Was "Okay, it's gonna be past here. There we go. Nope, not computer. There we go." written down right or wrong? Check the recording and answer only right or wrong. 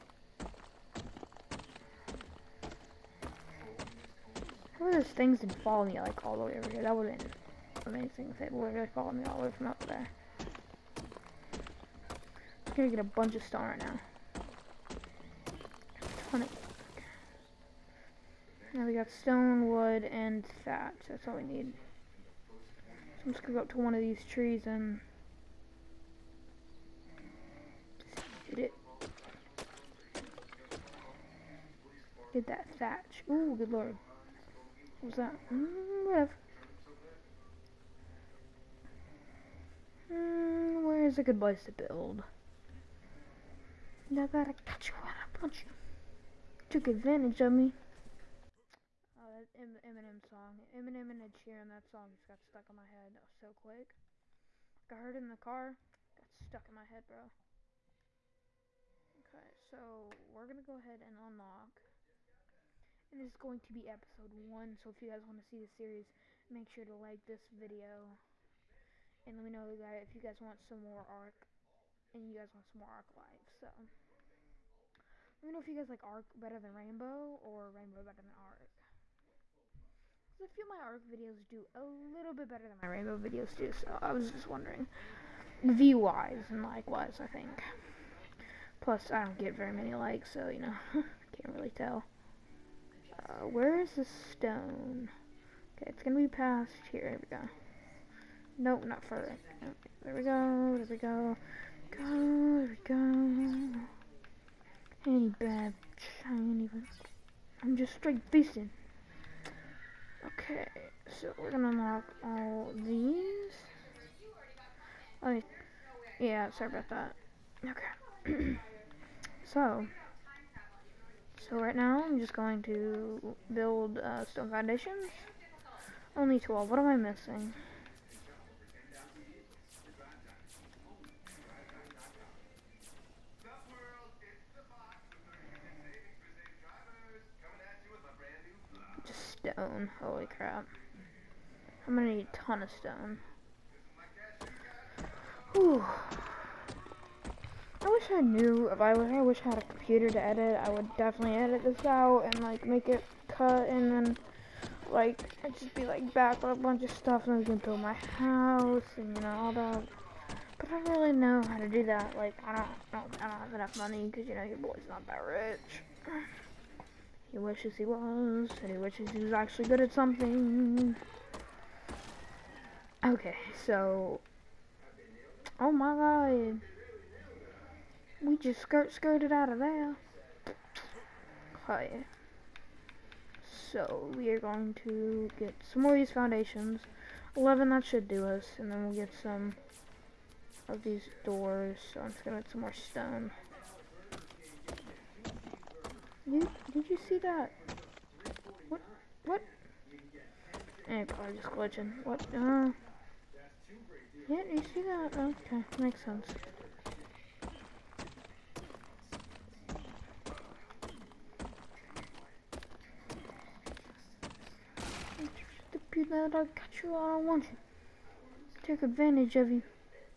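wrong.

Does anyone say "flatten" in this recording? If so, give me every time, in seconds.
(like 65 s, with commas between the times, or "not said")
not said.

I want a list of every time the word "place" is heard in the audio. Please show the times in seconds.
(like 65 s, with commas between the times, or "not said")
41 s.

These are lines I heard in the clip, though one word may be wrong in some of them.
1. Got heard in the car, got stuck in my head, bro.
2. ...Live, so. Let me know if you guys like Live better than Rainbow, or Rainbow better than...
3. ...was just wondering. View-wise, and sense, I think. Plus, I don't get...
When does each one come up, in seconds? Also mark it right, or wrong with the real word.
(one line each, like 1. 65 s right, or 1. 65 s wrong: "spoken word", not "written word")
1. 54 s right
2. 73 s wrong: "ARK", not "Live"
3. 84 s wrong: "likewise", not "sense".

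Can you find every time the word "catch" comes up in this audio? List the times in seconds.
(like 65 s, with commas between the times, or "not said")
44 s, 216 s.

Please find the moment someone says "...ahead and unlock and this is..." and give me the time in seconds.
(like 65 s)
60 s.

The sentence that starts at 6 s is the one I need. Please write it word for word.
That would've been amazing if they literally followed me all the way from up there.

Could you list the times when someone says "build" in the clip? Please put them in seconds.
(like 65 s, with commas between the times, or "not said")
41 s, 123 s, 157 s.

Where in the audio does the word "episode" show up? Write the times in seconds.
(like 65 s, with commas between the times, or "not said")
63 s.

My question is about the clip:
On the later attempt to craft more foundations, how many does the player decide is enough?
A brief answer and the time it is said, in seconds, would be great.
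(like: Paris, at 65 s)
11, at 187 s.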